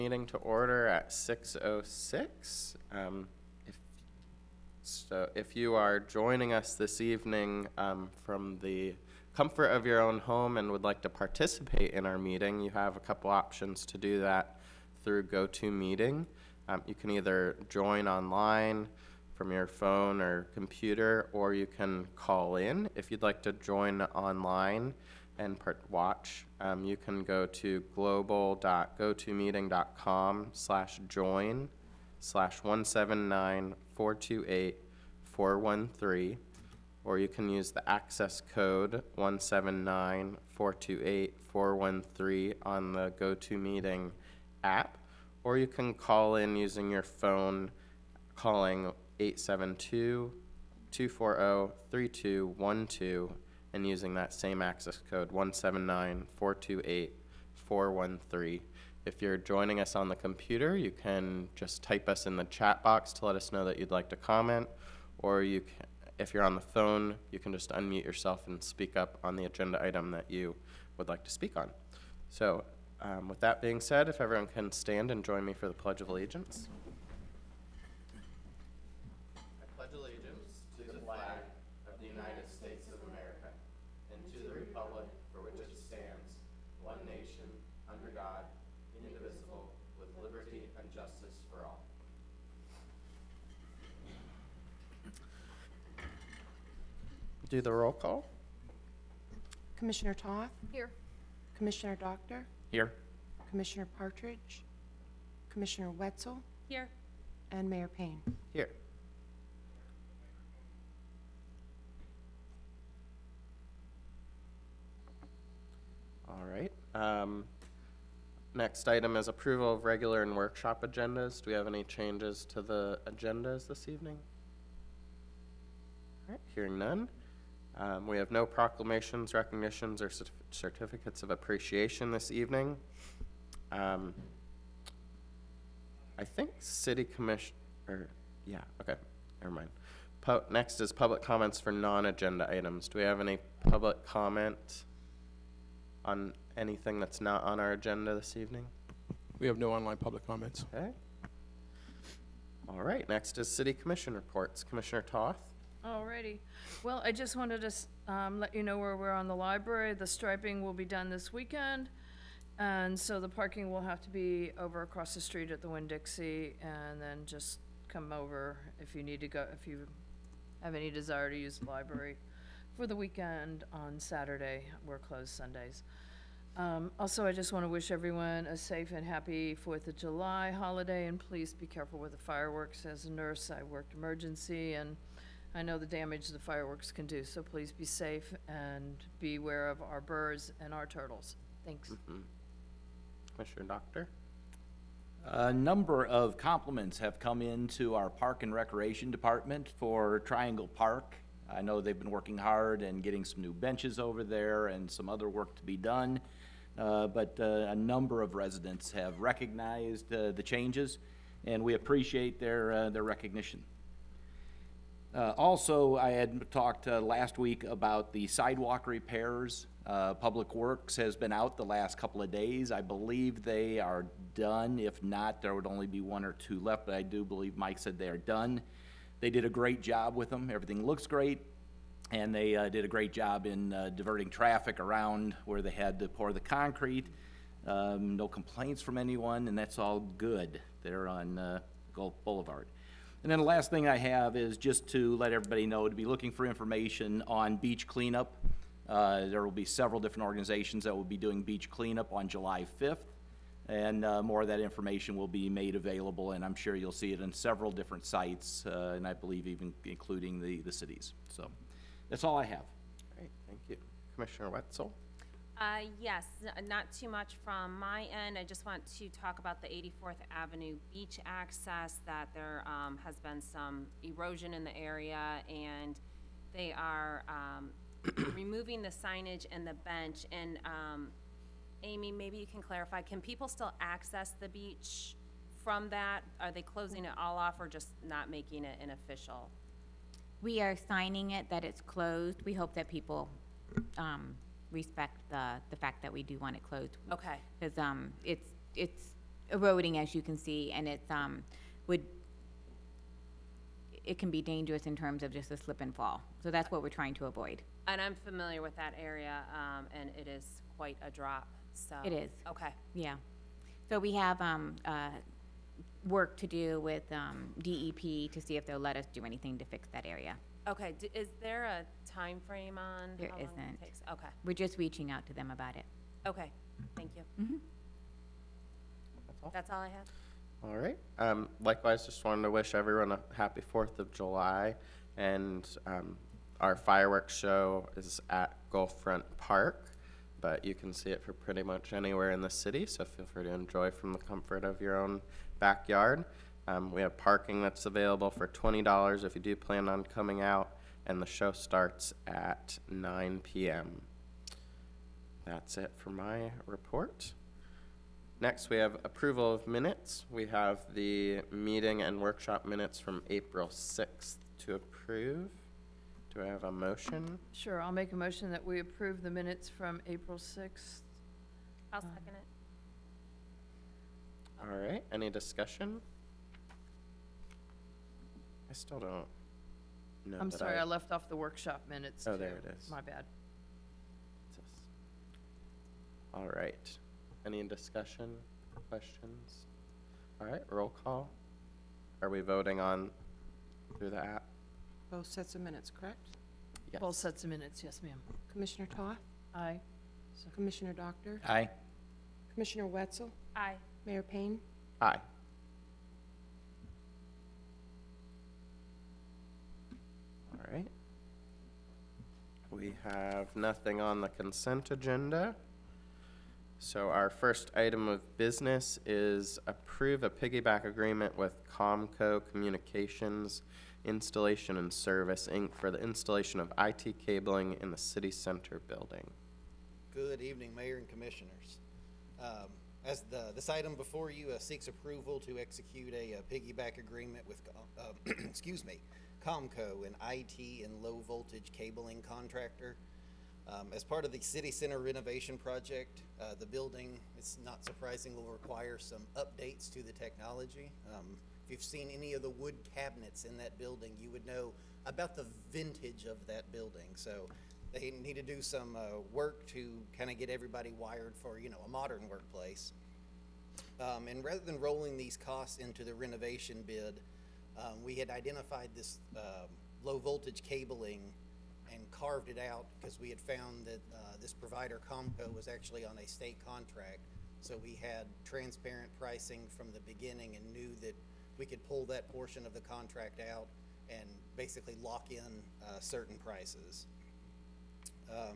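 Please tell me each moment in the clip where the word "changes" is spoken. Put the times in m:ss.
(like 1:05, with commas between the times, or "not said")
2:01, 3:30.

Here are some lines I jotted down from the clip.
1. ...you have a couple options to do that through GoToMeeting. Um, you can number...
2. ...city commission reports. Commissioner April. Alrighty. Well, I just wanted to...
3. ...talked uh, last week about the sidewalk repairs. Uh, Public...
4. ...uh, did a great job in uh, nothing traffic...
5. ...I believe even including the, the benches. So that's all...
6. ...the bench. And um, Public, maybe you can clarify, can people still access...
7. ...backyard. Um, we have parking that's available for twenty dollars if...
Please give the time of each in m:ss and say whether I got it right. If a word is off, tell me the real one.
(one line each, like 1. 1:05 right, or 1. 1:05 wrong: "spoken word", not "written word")
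1. 0:12 wrong: "either", not "number"
2. 2:33 wrong: "Toth", not "April"
3. 3:36 right
4. 3:52 wrong: "diverting", not "nothing"
5. 4:19 wrong: "cities", not "benches"
6. 4:39 wrong: "Amy", not "Public"
7. 5:45 right.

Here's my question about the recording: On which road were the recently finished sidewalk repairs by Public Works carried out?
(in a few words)
Gulf Boulevard.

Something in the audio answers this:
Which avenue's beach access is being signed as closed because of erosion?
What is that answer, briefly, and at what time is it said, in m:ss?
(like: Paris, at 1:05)
84th Avenue, at 4:29.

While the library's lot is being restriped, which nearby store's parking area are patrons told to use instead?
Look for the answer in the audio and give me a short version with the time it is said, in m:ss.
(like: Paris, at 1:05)
Winn-Dixie, at 2:45.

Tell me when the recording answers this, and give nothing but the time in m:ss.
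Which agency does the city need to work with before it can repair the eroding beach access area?
5:17.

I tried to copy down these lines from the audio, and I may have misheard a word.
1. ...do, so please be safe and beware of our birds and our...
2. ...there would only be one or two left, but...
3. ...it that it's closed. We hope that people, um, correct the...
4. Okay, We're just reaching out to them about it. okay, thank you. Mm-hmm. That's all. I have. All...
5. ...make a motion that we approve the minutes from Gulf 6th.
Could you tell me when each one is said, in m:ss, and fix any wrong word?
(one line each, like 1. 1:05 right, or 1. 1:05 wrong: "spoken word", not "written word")
1. 3:07 right
2. 3:45 right
3. 4:51 wrong: "respect", not "correct"
4. 5:24 right
5. 6:07 wrong: "April", not "Gulf".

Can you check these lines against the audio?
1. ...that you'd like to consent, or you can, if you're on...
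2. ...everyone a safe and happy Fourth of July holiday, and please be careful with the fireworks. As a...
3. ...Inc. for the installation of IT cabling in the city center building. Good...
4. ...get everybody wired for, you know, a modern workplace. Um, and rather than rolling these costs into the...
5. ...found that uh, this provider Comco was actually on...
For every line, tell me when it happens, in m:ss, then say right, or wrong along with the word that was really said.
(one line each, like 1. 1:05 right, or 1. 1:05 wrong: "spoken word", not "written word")
1. 1:03 wrong: "comment", not "consent"
2. 2:57 right
3. 7:05 right
4. 7:40 right
5. 7:53 right.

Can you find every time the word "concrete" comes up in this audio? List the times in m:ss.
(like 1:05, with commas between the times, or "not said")
3:56.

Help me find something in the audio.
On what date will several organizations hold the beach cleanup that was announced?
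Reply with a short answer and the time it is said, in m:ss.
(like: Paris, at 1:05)
July 5th, at 4:12.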